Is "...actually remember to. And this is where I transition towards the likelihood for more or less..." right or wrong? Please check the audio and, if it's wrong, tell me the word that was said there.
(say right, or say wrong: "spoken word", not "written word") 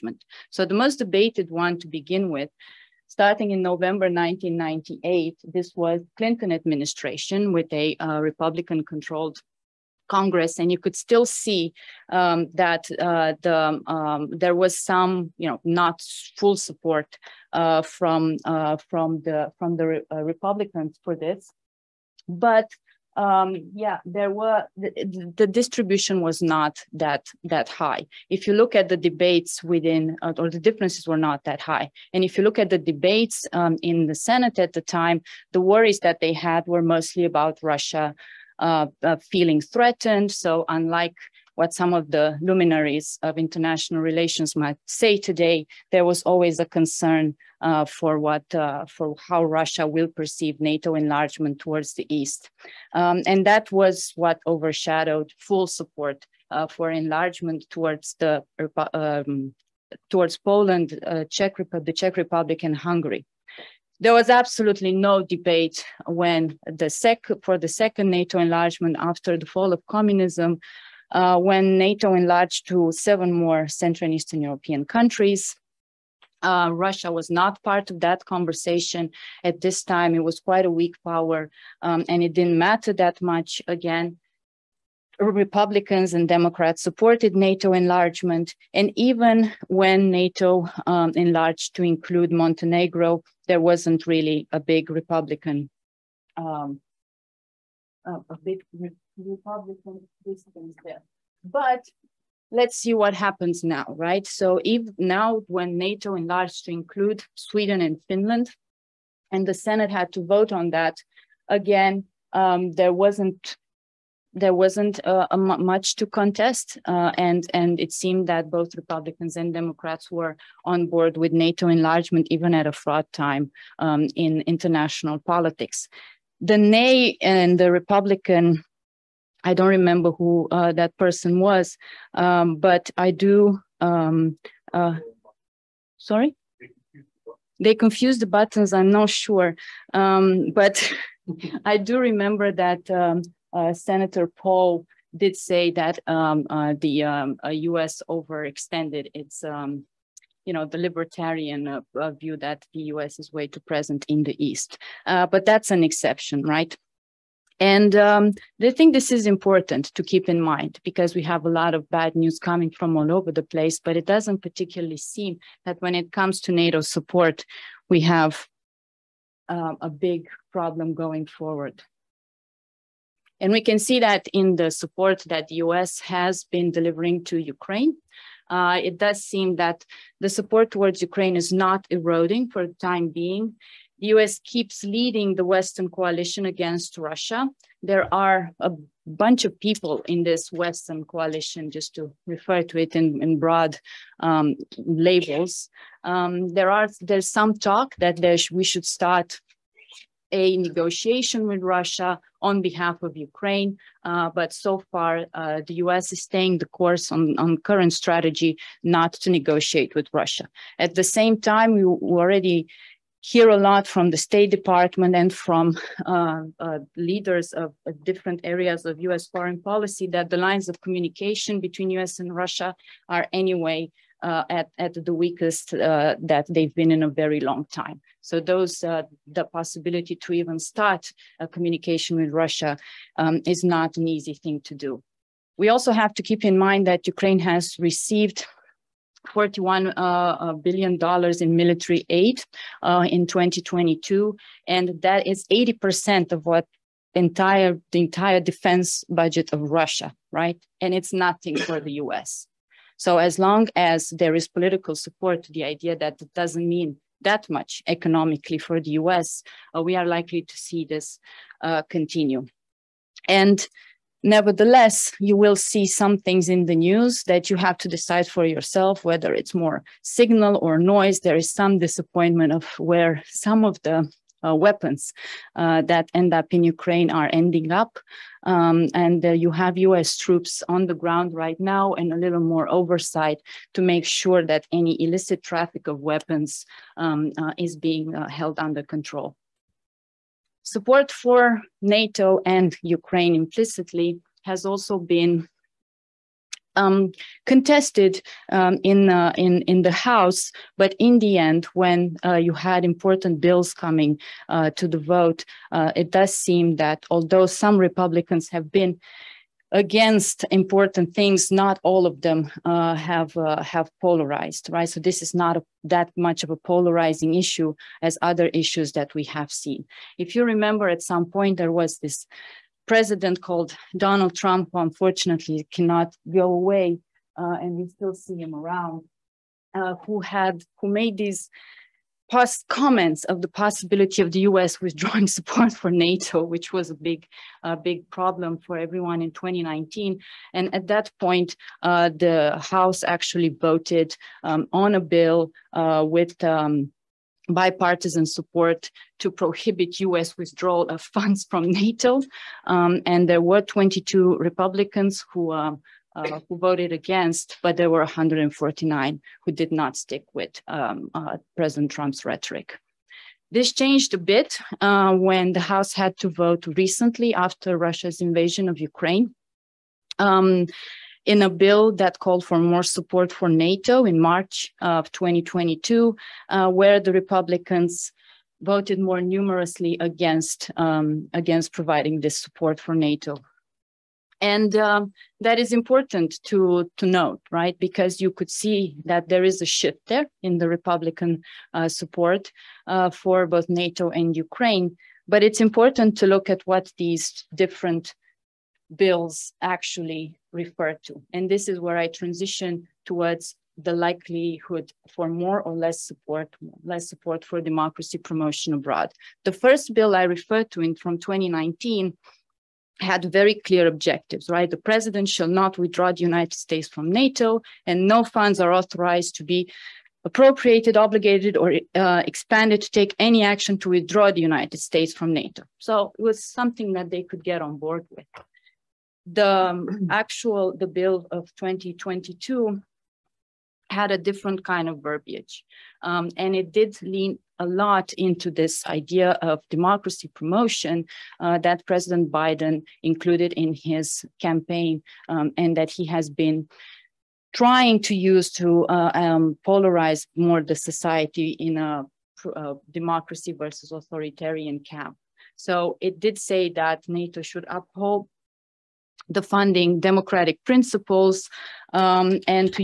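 wrong: "refer", not "remember".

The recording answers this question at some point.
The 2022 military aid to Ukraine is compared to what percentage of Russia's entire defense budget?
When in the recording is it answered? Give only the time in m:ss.
4:05.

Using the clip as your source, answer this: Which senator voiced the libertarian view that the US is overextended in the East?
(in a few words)
Senator Paul.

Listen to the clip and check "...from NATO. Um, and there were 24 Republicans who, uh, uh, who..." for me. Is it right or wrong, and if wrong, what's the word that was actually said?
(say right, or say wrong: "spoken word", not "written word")
wrong: "22", not "24".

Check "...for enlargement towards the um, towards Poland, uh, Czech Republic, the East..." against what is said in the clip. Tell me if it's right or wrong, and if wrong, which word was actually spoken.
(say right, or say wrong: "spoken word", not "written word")
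wrong: "Czech", not "East".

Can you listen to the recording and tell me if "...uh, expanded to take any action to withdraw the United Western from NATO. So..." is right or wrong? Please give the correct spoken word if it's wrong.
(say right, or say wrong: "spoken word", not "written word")
wrong: "States", not "Western".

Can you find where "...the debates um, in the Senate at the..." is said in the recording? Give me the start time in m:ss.
0:32.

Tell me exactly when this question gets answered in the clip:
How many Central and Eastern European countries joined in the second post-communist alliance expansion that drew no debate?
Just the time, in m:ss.
1:12.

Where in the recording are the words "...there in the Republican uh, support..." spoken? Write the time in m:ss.
6:30.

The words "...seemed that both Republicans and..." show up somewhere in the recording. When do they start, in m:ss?
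1:57.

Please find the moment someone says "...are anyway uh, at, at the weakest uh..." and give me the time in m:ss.
3:43.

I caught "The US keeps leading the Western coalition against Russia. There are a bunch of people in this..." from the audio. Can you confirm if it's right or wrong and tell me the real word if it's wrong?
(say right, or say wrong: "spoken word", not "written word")
right.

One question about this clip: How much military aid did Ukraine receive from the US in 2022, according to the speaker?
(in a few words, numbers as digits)
$41 billion.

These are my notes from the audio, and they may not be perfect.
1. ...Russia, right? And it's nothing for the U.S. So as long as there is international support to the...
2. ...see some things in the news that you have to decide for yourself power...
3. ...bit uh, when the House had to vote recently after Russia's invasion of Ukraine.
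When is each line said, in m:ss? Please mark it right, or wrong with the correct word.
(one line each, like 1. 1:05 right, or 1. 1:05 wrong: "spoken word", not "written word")
1. 4:09 wrong: "political", not "international"
2. 4:25 wrong: "whether", not "power"
3. 6:04 right.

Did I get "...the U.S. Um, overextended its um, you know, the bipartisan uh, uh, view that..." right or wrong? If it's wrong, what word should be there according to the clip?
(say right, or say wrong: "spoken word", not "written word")
wrong: "libertarian", not "bipartisan".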